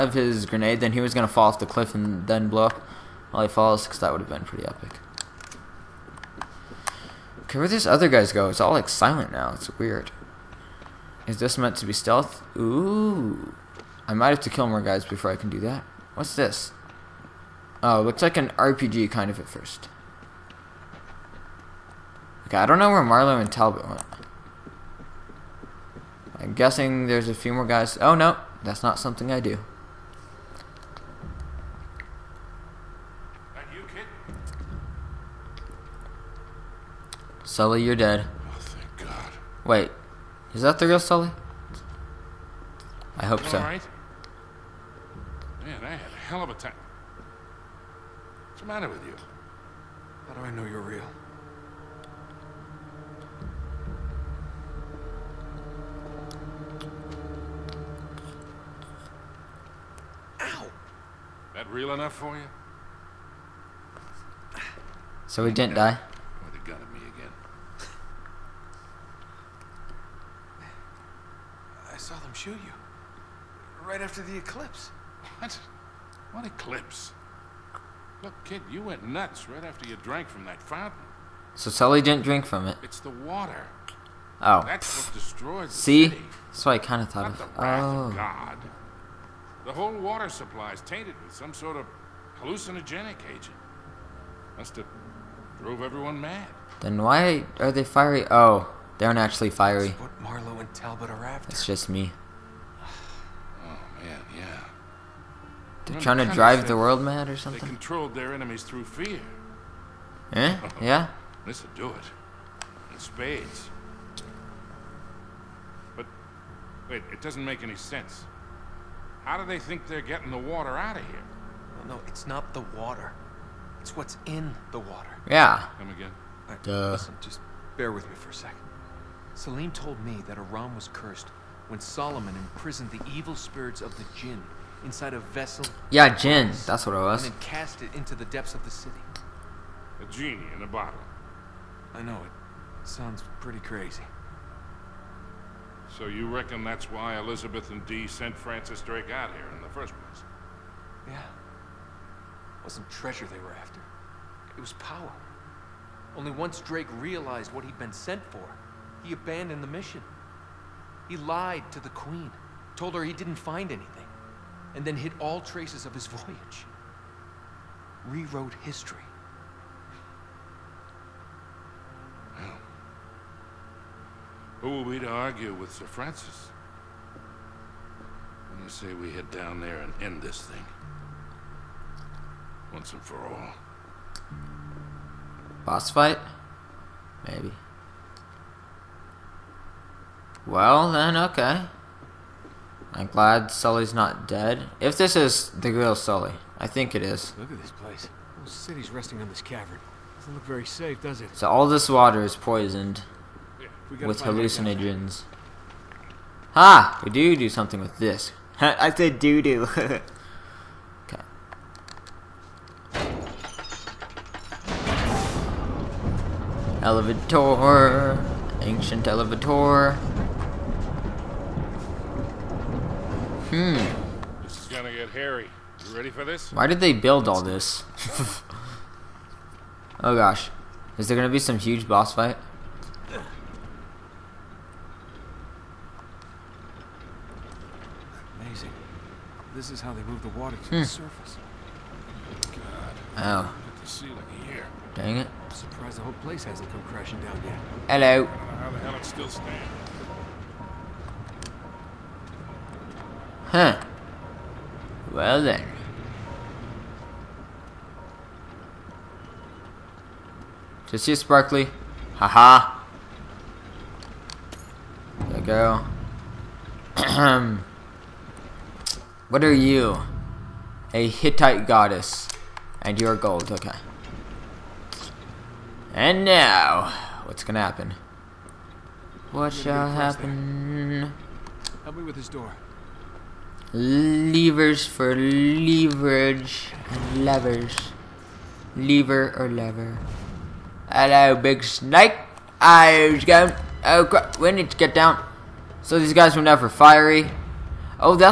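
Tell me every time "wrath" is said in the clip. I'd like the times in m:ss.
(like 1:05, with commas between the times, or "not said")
1:27.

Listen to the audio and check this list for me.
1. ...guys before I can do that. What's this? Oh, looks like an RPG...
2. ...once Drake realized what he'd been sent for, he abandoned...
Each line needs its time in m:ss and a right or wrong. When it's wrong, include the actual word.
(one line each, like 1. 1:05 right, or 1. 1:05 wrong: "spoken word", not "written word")
1. 0:14 right
2. 2:36 right.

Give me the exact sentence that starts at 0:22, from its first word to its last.
Okay, I don't know where Marlowe and Talbot went.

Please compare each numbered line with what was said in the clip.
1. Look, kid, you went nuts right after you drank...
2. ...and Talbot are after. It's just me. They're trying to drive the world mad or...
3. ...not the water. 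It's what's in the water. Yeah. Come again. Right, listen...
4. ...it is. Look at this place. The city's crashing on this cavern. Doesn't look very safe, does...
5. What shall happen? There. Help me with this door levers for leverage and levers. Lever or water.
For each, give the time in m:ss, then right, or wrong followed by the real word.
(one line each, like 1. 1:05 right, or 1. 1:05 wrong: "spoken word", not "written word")
1. 1:18 right
2. 1:40 right
3. 2:02 right
4. 3:16 wrong: "resting", not "crashing"
5. 4:39 wrong: "lever", not "water".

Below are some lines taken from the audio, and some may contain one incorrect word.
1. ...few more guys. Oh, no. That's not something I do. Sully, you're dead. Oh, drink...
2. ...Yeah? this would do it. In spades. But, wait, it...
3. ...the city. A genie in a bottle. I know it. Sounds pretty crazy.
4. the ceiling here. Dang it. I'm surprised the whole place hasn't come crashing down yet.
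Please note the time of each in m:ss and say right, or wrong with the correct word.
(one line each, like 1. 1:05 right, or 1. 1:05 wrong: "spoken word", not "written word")
1. 0:27 wrong: "thank", not "drink"
2. 1:50 right
3. 2:18 right
4. 4:03 right.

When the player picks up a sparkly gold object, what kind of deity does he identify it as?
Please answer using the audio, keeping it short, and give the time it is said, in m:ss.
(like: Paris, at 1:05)
A Hittite goddess, at 4:30.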